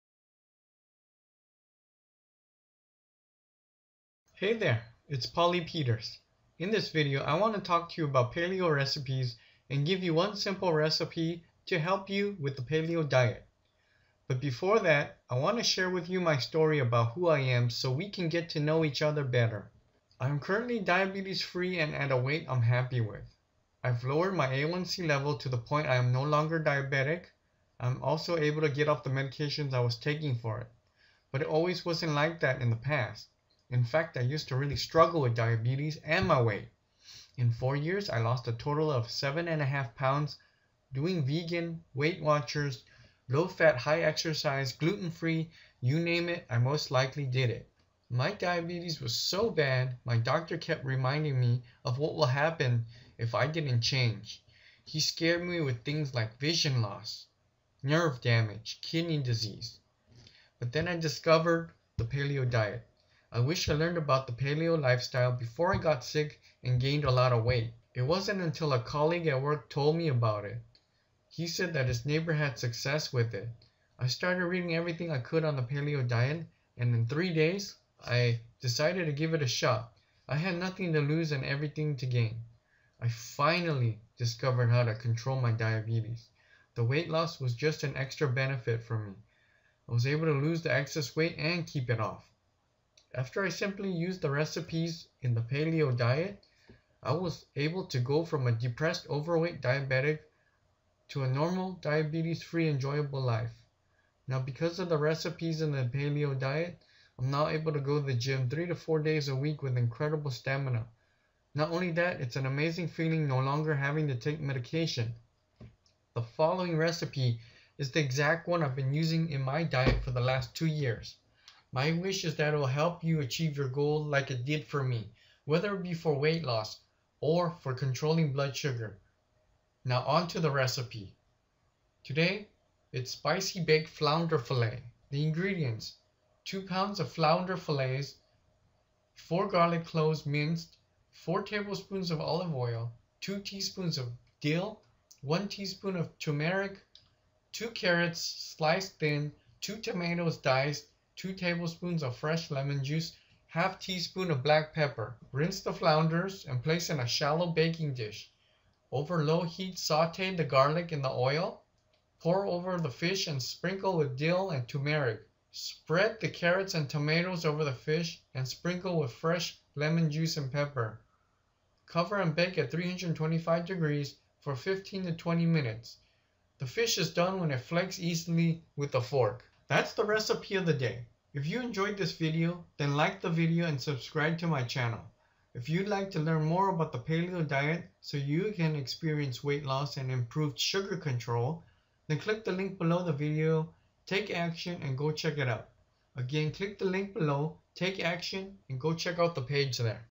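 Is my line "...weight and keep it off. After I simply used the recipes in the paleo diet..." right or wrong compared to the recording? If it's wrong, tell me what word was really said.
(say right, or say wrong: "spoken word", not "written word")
right.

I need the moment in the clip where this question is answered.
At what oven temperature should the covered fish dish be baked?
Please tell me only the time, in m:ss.
2:52.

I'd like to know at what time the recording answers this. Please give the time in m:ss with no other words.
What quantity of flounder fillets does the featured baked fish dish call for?
2:16.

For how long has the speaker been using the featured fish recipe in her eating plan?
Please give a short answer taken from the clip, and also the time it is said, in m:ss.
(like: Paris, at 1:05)
2 years, at 2:00.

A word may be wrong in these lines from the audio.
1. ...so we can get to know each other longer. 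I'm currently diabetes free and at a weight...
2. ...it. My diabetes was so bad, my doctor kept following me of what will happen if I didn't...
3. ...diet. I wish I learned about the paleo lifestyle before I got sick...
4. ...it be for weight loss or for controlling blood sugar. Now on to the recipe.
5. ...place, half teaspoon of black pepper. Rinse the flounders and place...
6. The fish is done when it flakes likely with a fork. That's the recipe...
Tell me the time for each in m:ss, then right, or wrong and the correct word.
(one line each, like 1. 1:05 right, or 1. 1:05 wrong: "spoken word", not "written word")
1. 0:17 wrong: "better", not "longer"
2. 0:47 wrong: "reminding", not "following"
3. 1:02 right
4. 2:05 right
5. 2:32 wrong: "juice", not "place"
6. 2:56 wrong: "easily", not "likely".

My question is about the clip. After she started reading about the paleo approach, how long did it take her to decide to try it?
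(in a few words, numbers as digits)
3 days.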